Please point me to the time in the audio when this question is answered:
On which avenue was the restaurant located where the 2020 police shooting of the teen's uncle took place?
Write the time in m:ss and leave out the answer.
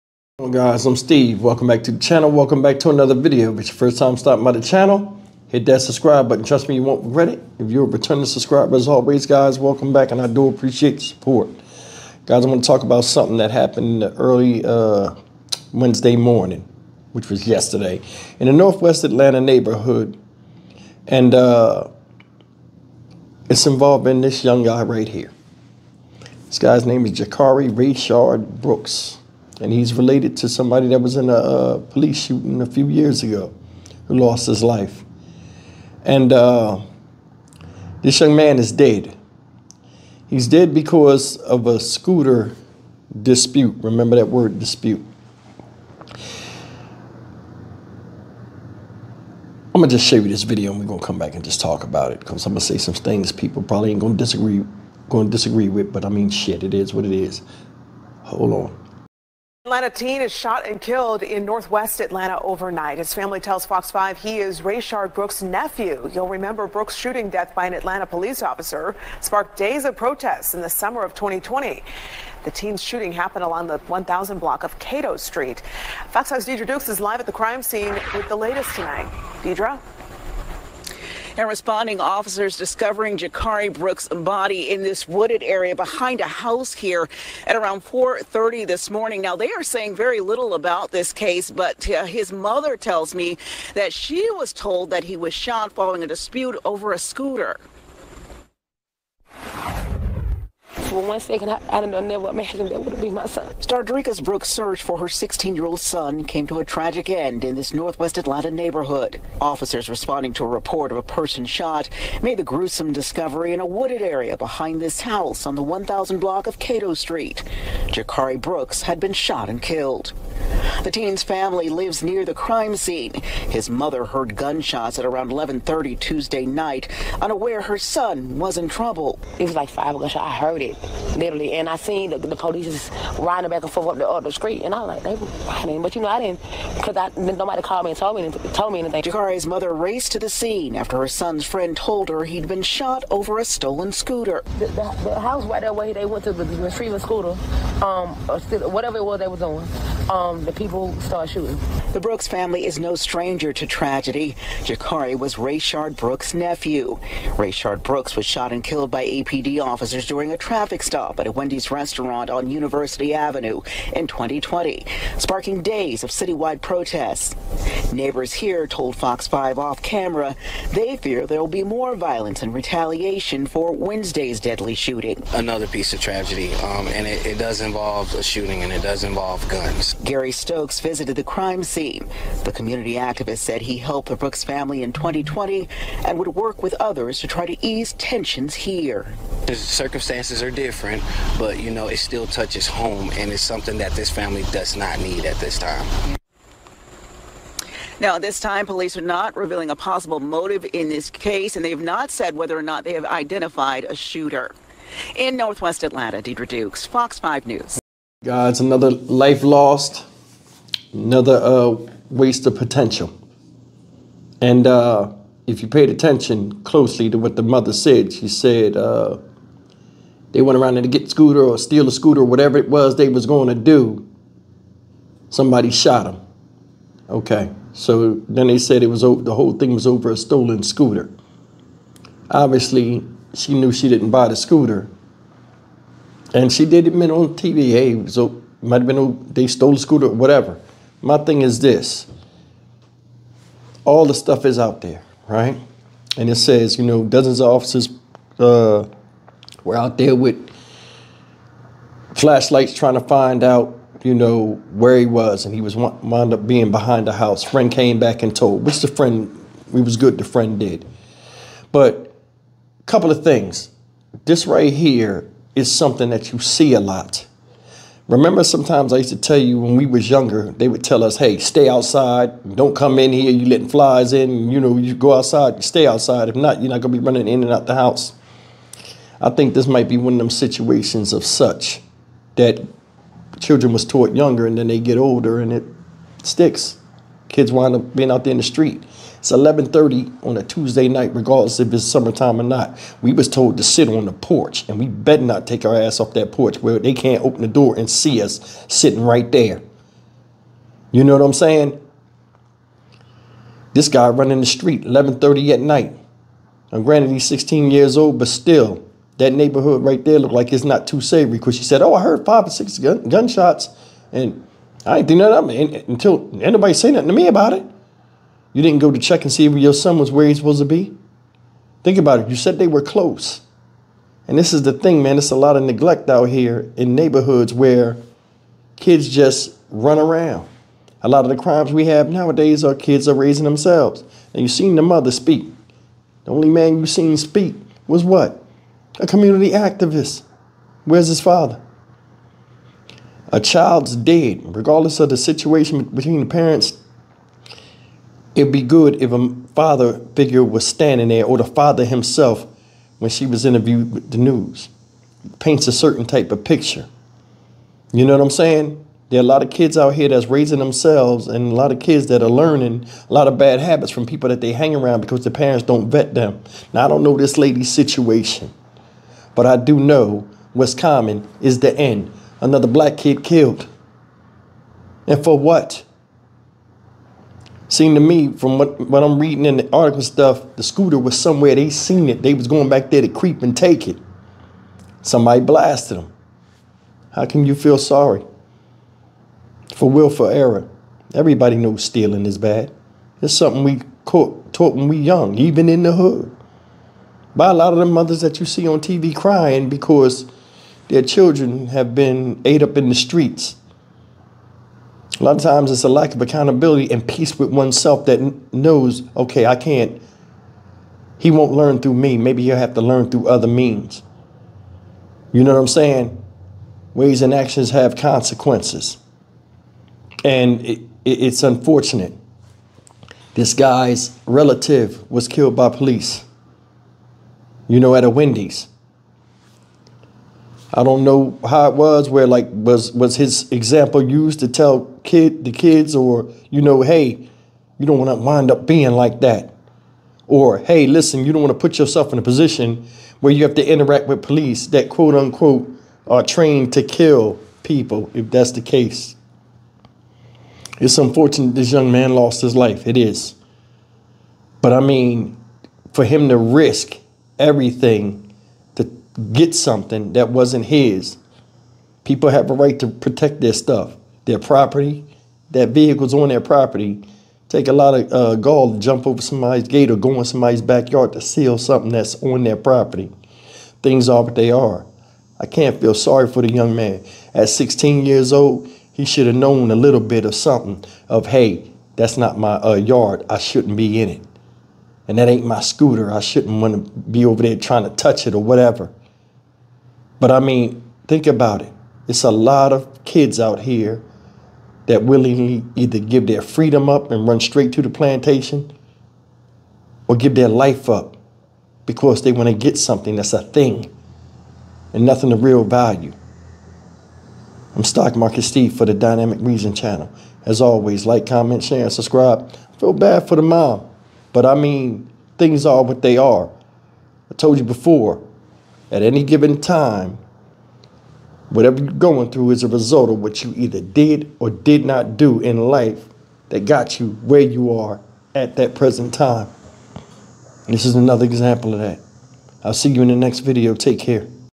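2:42.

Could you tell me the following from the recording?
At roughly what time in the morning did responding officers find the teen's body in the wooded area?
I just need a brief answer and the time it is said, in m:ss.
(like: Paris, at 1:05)
4:30, at 1:27.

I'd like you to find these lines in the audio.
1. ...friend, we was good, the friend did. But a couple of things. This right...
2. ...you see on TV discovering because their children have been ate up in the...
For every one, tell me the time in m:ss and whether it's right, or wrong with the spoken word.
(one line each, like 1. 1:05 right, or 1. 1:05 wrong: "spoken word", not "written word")
1. 4:18 right
2. 6:38 wrong: "crying", not "discovering".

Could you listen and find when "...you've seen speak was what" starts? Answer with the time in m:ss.
5:36.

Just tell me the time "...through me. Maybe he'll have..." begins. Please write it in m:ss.
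6:51.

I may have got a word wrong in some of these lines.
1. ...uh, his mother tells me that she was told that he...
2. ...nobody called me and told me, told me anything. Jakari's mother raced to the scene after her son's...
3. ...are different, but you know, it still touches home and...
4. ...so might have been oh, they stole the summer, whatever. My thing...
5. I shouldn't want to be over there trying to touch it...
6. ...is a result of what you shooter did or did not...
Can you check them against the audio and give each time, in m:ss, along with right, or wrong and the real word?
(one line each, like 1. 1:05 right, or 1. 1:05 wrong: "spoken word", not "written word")
1. 1:31 right
2. 2:17 right
3. 3:10 right
4. 3:58 wrong: "scooter", not "summer"
5. 8:06 right
6. 8:42 wrong: "either", not "shooter".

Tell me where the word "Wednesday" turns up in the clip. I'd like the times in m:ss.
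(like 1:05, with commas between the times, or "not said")
0:15, 2:53.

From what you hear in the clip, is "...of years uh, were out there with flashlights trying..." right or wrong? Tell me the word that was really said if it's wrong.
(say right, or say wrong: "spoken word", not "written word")
wrong: "officers", not "years".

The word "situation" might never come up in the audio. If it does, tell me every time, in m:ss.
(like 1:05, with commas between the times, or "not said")
4:40, 5:45, 6:07.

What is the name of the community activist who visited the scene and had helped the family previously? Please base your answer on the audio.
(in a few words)
Gary Stokes.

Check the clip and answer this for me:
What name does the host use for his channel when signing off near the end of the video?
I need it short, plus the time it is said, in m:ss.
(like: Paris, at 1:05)
Dynamic Reason, at 8:28.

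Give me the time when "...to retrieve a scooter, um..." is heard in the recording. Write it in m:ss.
2:26.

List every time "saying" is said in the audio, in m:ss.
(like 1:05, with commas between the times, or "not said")
1:29, 5:01, 5:58, 6:55.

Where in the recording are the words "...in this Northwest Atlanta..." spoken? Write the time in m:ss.
1:47.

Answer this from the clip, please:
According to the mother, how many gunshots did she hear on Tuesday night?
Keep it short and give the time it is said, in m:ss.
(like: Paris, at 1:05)
5, at 2:09.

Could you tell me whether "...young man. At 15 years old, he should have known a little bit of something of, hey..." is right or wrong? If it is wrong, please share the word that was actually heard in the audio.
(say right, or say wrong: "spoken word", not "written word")
wrong: "16", not "15".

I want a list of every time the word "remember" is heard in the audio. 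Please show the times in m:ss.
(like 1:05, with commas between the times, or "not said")
0:43, 1:06, 4:28.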